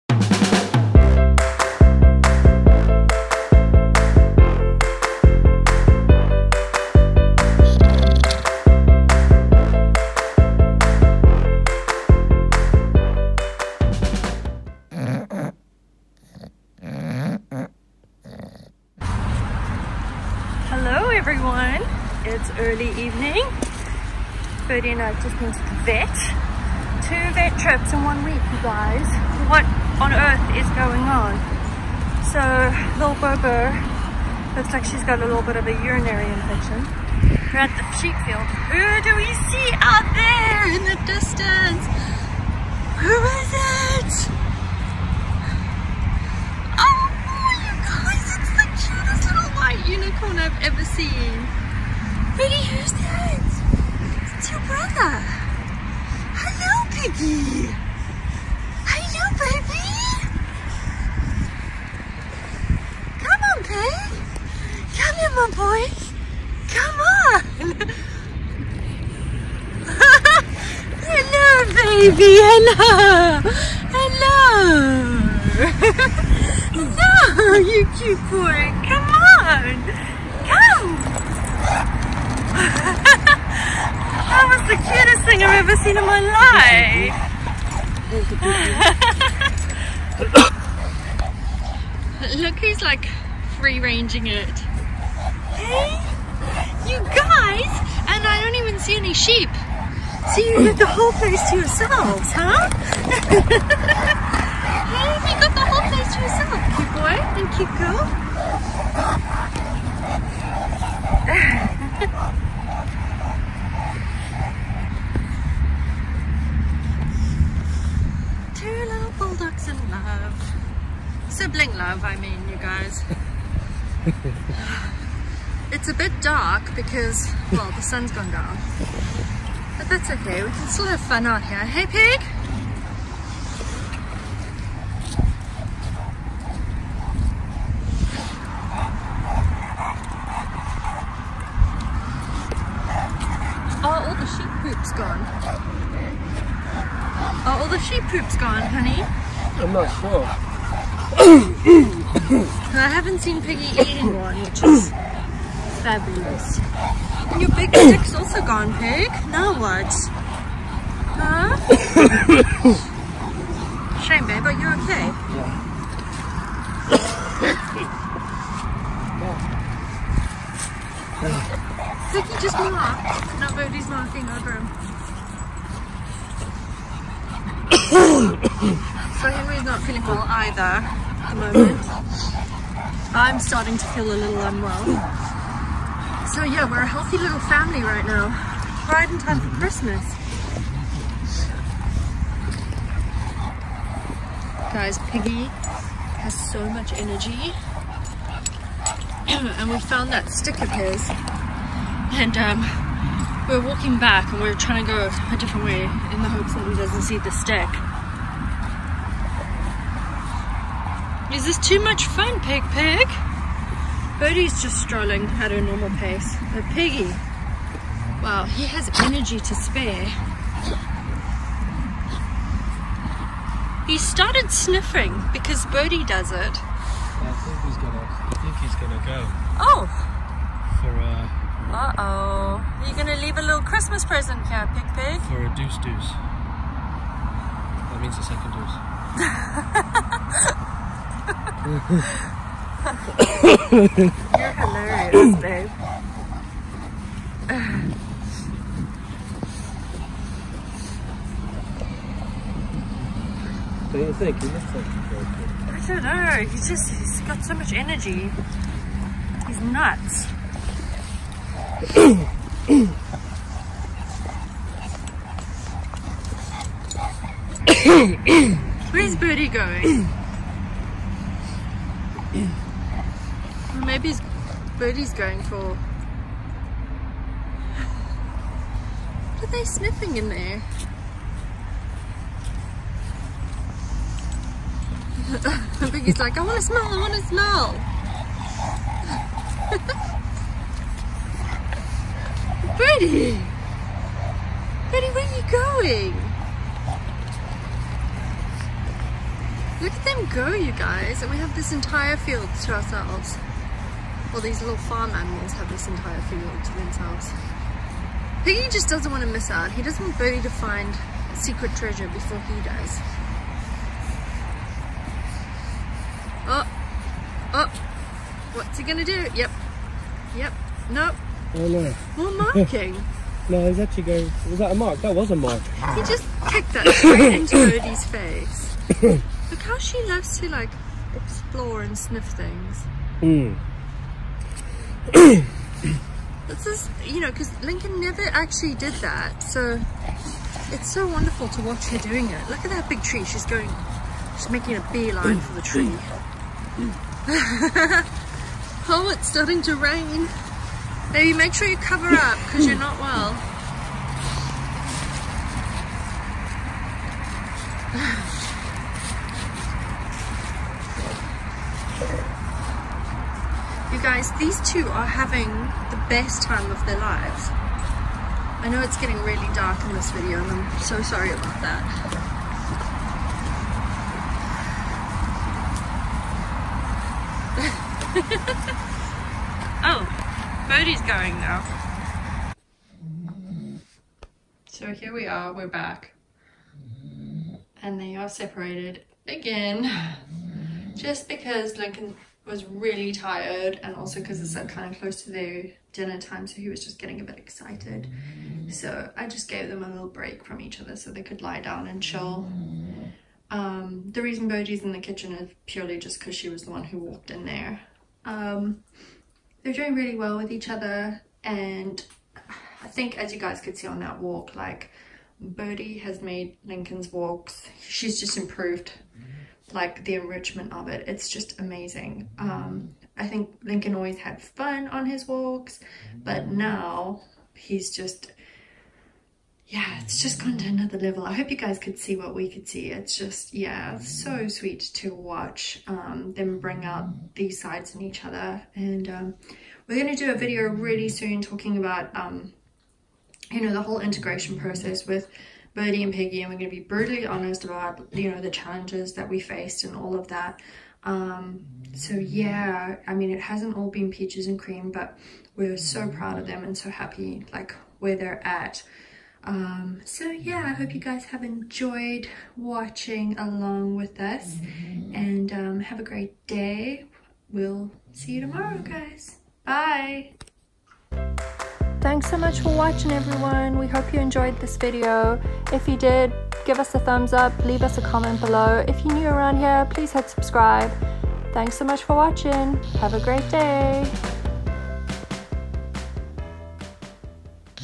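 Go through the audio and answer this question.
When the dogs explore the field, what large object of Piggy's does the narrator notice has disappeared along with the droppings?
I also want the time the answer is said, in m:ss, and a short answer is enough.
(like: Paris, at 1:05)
Big stick, at 2:37.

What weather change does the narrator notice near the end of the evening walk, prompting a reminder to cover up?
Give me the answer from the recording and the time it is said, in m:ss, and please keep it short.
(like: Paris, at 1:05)
Rain, at 5:49.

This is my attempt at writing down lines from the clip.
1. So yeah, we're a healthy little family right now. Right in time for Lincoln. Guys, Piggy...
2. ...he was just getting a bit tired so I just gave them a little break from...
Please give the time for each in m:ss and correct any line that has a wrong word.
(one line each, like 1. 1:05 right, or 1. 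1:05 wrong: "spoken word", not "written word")
1. 3:06 wrong: "Christmas", not "Lincoln"
2. 6:36 wrong: "excited", not "tired".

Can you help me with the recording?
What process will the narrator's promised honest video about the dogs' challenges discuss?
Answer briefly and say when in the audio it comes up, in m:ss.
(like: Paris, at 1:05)
Integration process, at 7:23.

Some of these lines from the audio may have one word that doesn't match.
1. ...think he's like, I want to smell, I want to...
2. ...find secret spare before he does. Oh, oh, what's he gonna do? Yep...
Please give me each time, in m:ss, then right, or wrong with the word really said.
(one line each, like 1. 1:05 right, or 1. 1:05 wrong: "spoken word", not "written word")
1. 4:45 right
2. 5:10 wrong: "treasure", not "spare".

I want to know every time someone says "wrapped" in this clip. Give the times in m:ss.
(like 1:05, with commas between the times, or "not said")
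not said.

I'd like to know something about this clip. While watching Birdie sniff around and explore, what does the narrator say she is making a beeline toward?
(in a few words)
Big tree.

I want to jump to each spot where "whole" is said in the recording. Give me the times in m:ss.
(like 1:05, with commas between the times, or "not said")
1:40, 1:45, 7:23.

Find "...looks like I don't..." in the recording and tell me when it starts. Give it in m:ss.
4:14.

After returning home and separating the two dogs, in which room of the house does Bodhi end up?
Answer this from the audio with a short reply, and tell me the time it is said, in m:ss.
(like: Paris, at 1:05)
Kitchen, at 6:44.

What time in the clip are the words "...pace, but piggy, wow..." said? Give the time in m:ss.
3:35.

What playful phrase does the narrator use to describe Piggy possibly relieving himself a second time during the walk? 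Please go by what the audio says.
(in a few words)
Deuce deuce.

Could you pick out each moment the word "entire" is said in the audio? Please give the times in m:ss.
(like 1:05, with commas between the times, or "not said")
5:01, 5:05.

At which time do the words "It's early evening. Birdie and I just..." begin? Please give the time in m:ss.
0:22.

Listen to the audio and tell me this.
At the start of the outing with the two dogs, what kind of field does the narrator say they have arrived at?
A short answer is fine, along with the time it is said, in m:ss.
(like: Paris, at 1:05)
Sheep field, at 0:37.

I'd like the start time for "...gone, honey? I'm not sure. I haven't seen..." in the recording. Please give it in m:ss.
2:28.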